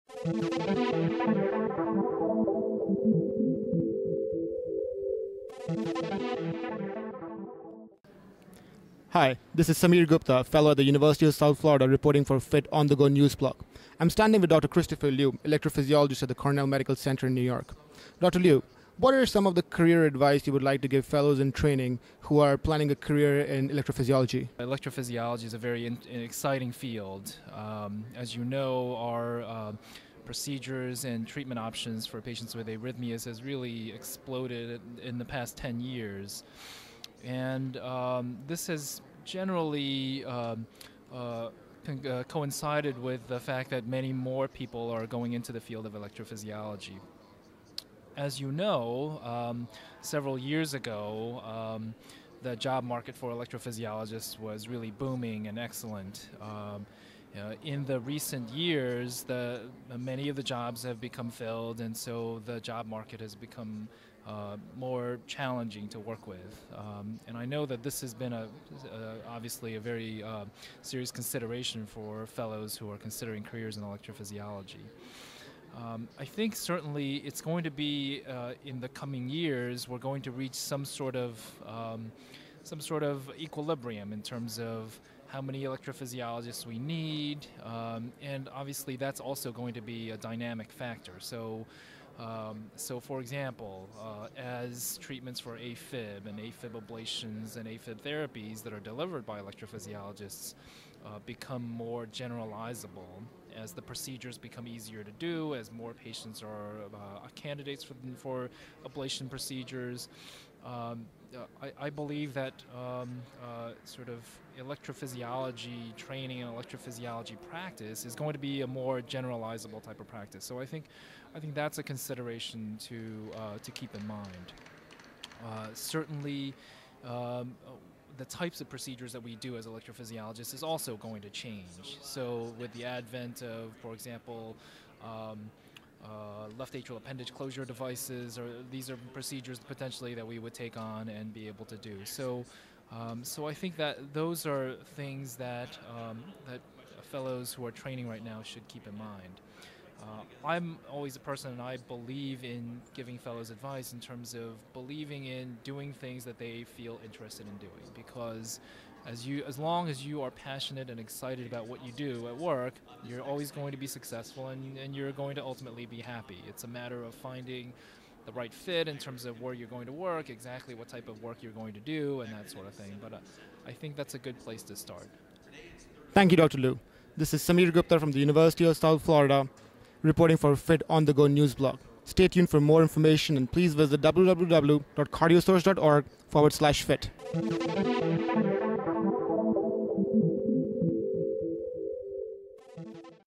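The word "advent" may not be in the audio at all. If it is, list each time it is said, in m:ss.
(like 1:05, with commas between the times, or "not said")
2:12.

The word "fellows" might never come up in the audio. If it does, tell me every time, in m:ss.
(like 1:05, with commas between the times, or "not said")
0:10, 0:21, 1:12, 2:27, 2:33.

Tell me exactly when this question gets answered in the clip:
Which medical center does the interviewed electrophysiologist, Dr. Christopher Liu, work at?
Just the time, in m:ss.
0:16.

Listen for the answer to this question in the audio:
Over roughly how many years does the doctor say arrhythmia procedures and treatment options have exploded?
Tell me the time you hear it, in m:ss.
0:35.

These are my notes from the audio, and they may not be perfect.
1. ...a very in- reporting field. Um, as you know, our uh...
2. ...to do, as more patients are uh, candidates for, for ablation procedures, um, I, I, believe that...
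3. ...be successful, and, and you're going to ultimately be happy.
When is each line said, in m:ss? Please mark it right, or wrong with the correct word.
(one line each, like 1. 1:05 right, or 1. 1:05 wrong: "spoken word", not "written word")
1. 0:25 wrong: "exciting", not "reporting"
2. 1:45 right
3. 2:43 right.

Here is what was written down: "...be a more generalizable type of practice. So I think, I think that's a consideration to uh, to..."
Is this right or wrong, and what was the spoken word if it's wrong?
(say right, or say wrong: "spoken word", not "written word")
right.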